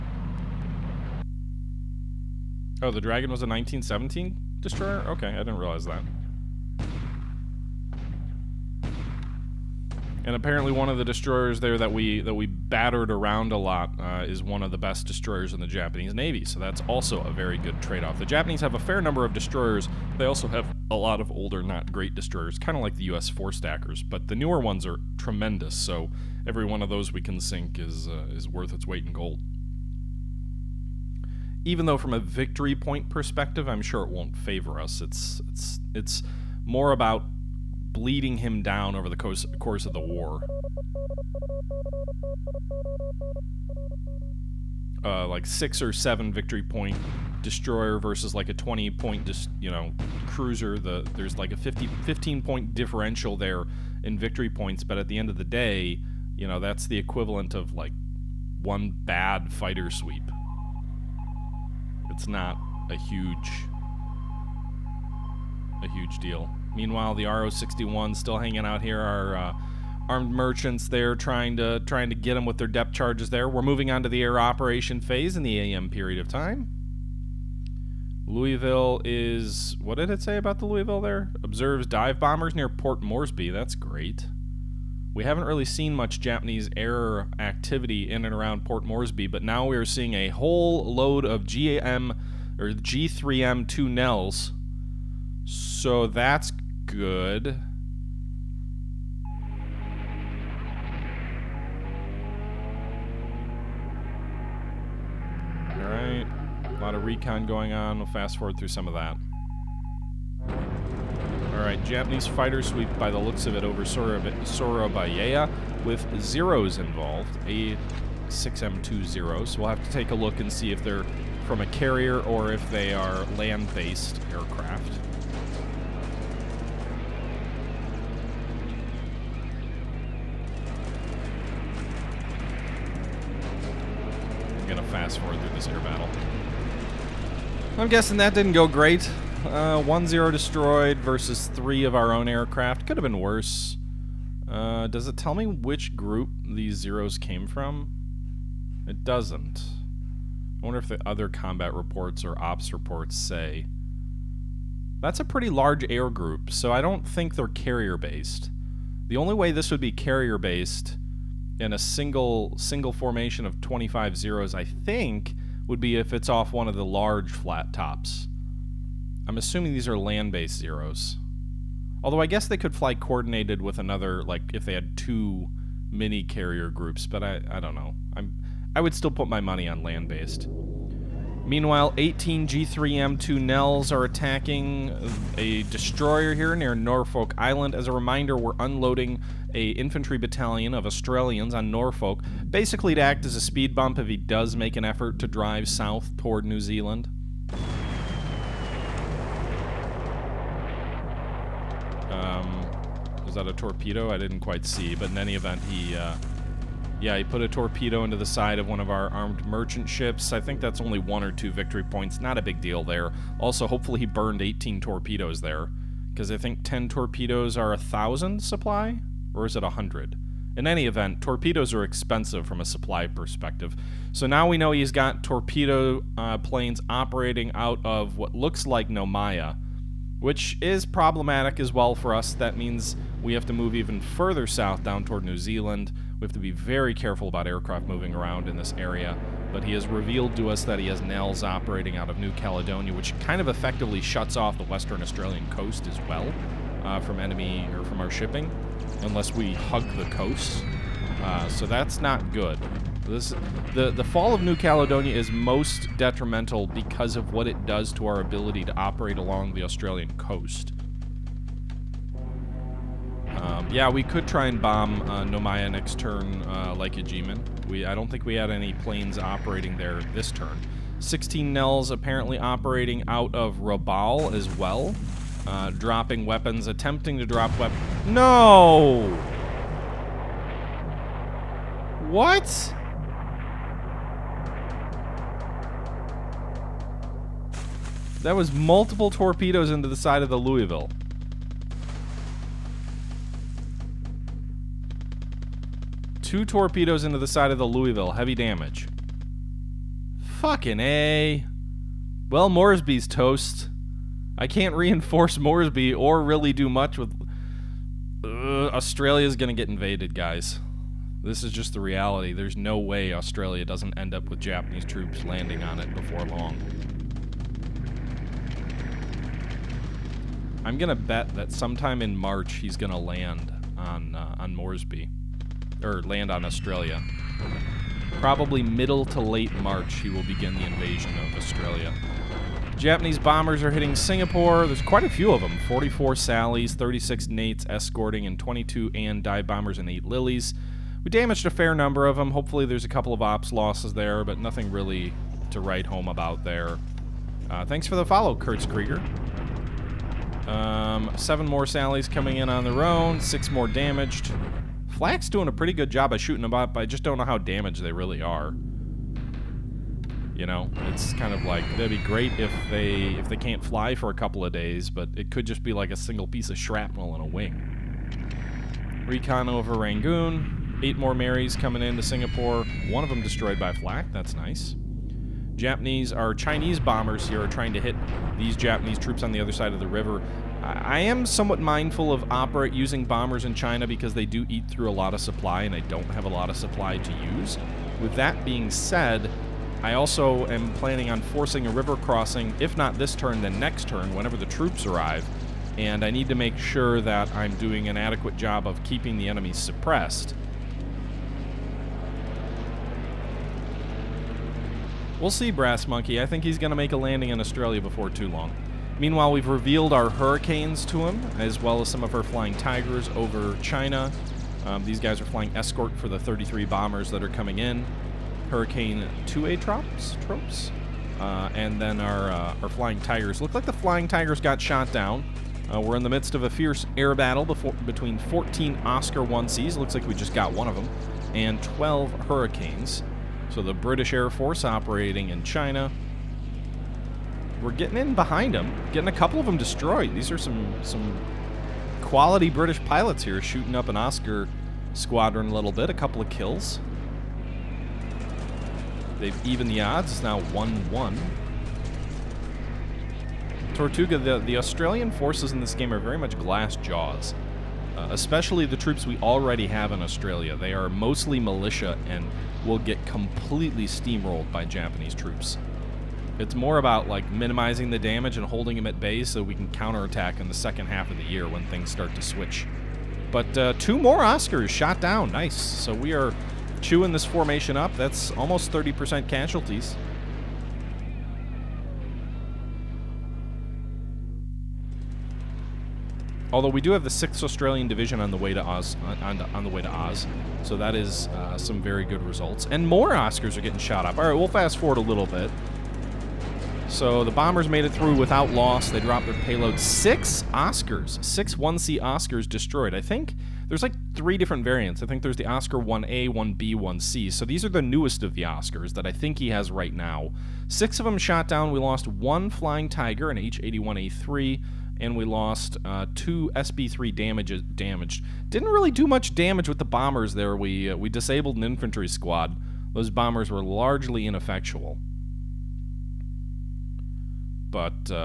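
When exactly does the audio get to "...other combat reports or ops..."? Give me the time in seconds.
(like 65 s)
151 s.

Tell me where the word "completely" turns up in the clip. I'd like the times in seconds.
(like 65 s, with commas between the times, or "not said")
463 s.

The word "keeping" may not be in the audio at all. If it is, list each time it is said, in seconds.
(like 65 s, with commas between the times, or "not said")
398 s.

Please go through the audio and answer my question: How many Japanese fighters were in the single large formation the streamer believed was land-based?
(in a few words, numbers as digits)
25.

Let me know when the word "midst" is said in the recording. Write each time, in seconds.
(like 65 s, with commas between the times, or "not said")
426 s.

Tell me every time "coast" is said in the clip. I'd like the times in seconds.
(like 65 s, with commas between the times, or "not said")
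245 s, 250 s, 260 s.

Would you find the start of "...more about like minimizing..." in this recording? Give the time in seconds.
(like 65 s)
466 s.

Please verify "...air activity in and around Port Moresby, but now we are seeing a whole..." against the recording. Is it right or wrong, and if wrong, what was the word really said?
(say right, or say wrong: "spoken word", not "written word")
right.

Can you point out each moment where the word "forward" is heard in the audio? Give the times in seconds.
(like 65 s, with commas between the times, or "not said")
108 s, 135 s, 494 s.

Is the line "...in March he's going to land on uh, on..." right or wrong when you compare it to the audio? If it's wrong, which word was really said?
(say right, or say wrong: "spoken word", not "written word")
right.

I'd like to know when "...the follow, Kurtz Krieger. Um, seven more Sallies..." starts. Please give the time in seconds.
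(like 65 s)
347 s.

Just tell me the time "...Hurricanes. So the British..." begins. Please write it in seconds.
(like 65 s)
432 s.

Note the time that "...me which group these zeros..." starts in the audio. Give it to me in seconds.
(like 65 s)
145 s.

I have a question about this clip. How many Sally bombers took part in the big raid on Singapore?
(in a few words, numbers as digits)
44.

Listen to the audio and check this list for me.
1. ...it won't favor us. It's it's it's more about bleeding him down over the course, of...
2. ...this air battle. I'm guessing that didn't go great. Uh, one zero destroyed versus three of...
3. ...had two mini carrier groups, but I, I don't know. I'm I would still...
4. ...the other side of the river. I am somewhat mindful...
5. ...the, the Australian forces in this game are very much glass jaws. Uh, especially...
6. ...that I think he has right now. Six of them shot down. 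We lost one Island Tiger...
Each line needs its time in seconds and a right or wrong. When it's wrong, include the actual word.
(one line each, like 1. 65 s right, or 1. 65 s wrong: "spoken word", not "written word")
1. 34 s right
2. 135 s right
3. 174 s right
4. 379 s right
5. 454 s right
6. 508 s wrong: "Flying", not "Island".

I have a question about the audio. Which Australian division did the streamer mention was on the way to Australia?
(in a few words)
Sixth Australian division.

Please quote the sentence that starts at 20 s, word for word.
They also have a lot of older, not great destroyers, kind of like the U.S.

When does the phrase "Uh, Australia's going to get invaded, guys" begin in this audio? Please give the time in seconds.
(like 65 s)
308 s.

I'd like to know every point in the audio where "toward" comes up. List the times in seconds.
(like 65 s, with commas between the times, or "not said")
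196 s, 235 s.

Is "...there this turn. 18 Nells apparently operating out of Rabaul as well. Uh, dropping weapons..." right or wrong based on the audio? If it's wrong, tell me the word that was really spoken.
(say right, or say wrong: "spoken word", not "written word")
wrong: "16", not "18".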